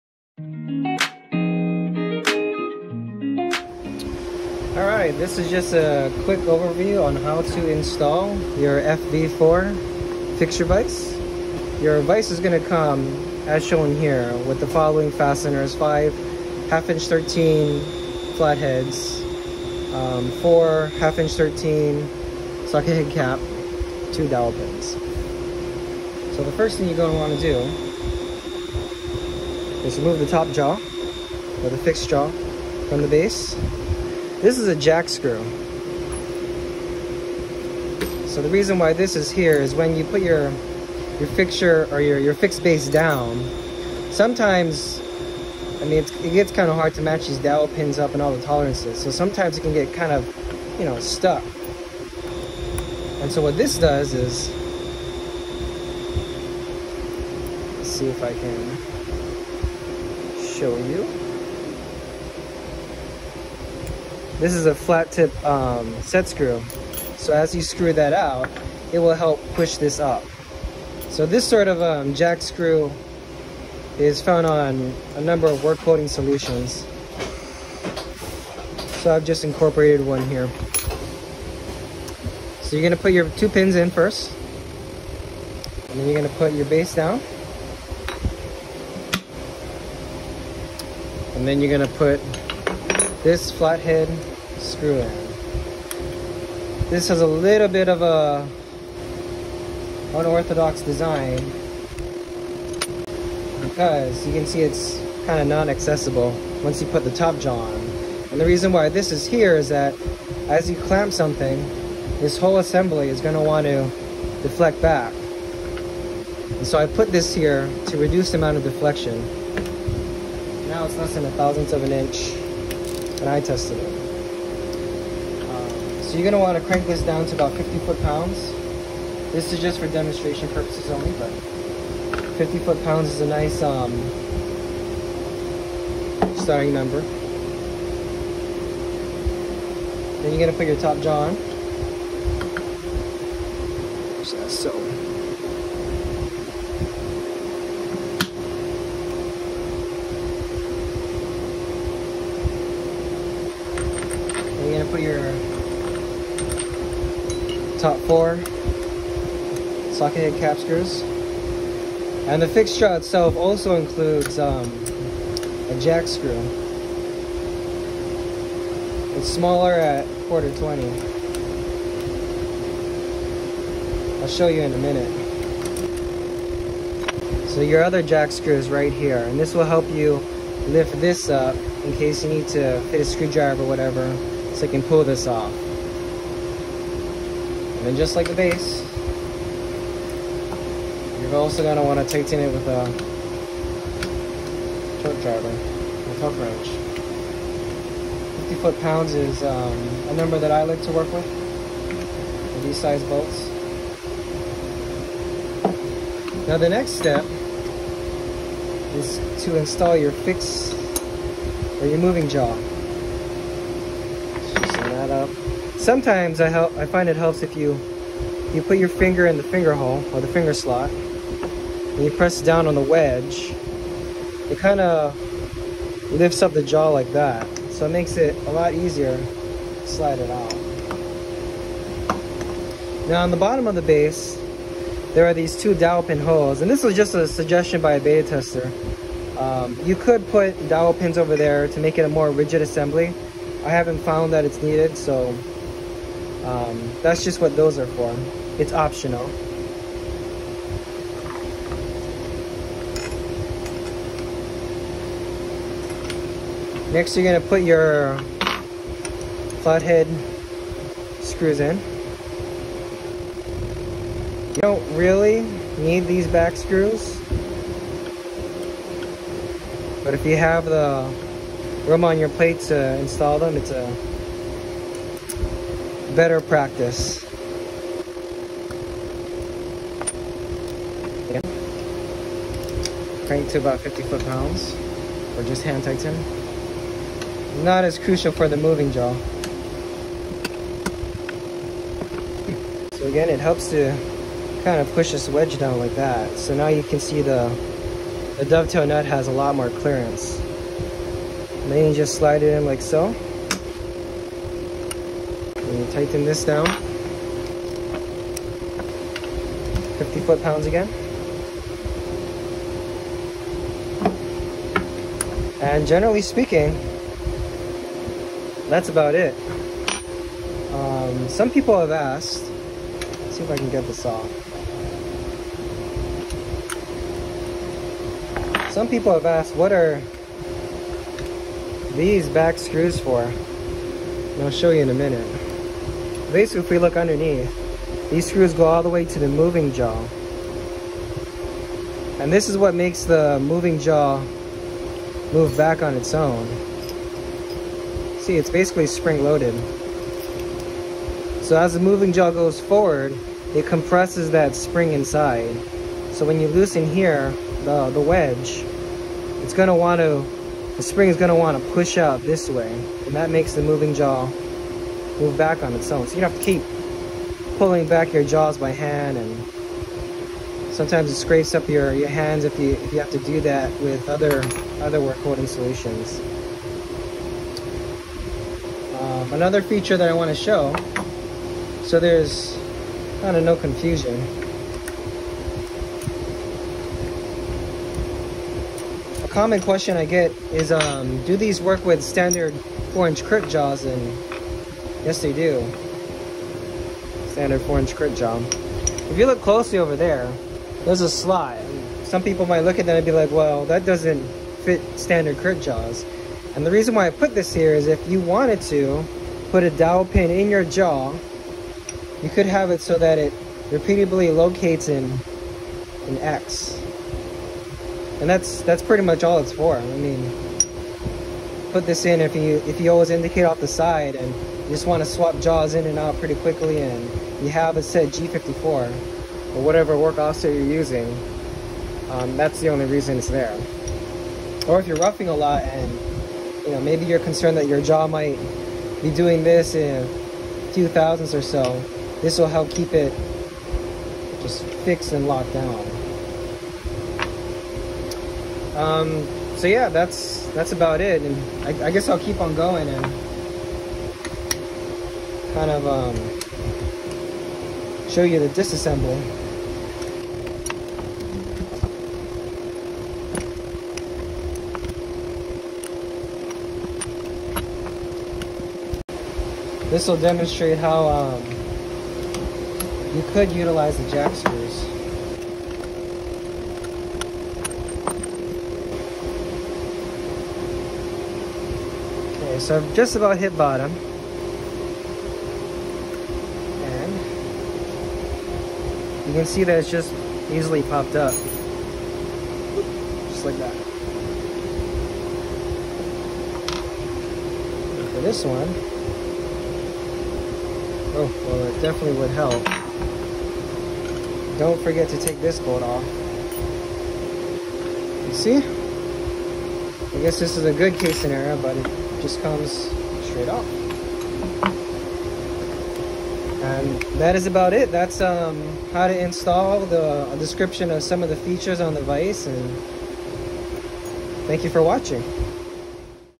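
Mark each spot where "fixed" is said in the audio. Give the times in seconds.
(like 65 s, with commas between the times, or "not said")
31 s, 42 s, 444 s.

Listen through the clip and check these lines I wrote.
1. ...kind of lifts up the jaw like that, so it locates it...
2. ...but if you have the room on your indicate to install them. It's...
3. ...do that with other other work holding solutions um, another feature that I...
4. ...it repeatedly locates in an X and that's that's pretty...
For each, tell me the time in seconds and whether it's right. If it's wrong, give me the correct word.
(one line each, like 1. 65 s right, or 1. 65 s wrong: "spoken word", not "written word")
1. 224 s wrong: "makes", not "locates"
2. 270 s wrong: "plate", not "indicate"
3. 373 s right
4. 413 s right.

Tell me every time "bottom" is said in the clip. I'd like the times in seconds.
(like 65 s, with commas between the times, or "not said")
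233 s, 483 s.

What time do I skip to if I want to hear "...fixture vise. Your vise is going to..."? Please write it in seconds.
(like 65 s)
10 s.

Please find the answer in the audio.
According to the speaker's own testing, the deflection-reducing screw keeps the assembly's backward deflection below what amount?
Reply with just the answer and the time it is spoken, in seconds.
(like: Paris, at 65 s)
a thousandth of an inch, at 120 s.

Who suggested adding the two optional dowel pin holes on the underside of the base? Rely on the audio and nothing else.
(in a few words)
A beta tester.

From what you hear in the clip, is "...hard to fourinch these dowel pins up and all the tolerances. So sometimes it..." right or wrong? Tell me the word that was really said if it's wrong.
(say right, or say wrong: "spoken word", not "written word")
wrong: "match", not "fourinch".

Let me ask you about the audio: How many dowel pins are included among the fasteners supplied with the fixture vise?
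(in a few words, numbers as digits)
2.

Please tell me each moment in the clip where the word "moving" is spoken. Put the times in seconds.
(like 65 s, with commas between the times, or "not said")
211 s, 288 s, 339 s, 343 s, 351 s, 363 s.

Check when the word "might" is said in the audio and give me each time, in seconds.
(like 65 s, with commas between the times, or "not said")
402 s, 438 s.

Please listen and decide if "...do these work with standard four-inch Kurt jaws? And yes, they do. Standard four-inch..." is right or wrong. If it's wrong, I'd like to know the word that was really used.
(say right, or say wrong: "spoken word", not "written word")
right.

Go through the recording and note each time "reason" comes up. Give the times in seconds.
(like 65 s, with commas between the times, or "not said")
38 s, 108 s, 406 s, 432 s.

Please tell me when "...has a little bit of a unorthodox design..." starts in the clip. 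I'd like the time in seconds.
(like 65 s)
97 s.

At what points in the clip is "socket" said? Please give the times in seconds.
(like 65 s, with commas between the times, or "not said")
22 s, 159 s.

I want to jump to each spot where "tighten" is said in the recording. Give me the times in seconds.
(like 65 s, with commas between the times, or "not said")
192 s, 285 s, 305 s.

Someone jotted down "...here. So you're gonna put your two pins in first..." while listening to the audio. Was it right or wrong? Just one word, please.
right.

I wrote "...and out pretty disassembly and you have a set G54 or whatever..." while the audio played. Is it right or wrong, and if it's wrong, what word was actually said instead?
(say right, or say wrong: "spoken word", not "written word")
wrong: "quickly", not "disassembly".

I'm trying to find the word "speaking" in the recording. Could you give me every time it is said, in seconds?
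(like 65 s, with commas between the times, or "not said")
316 s.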